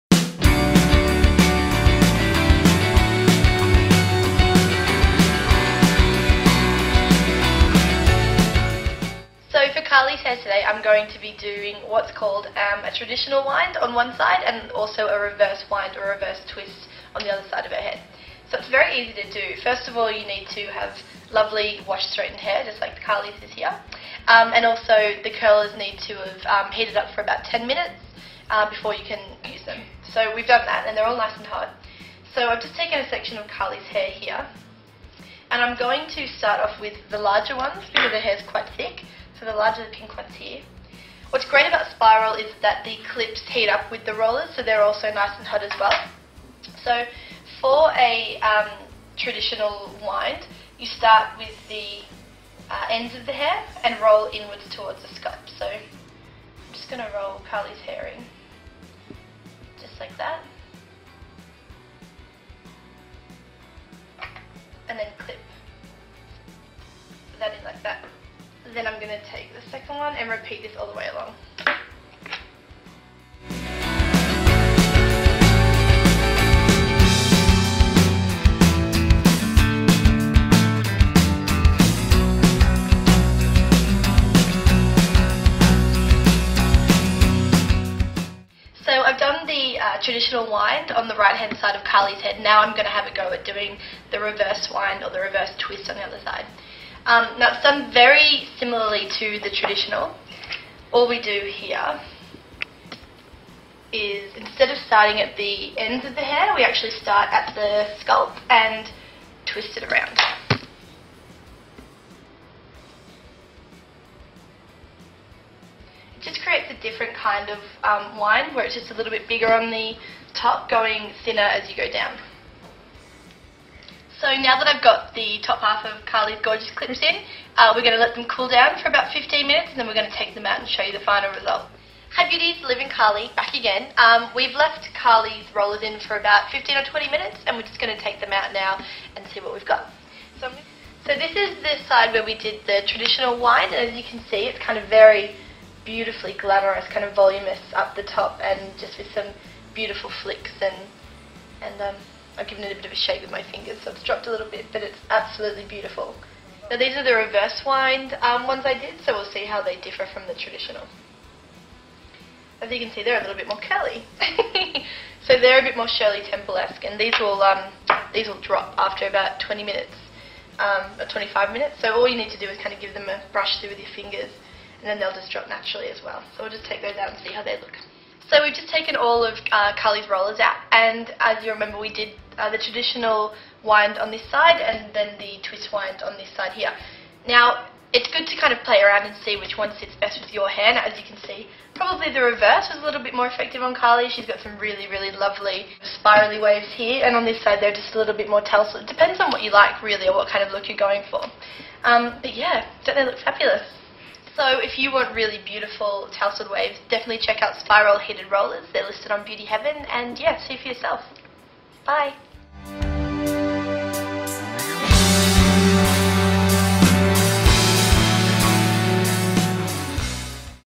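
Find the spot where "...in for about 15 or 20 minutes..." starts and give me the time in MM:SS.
02:15.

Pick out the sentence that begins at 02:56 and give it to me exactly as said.
So we'll just take those out and see how they look.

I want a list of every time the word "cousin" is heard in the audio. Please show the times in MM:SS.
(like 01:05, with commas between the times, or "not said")
not said.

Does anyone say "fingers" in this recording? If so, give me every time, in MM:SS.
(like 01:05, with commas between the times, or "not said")
02:33, 02:53.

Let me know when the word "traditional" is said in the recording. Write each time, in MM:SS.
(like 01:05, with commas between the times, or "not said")
00:12, 00:49, 01:30, 01:39, 02:22, 02:40, 03:02.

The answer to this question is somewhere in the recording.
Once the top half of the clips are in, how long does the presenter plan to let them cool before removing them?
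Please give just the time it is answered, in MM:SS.
02:09.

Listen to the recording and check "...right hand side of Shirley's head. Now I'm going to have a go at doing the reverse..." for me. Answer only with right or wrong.
wrong.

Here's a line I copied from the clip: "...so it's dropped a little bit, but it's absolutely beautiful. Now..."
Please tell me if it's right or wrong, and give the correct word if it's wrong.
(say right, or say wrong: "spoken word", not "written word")
right.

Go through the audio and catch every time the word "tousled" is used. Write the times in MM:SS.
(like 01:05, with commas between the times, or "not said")
03:18, 03:26.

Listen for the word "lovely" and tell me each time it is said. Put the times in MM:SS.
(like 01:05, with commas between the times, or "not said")
00:21, 03:15.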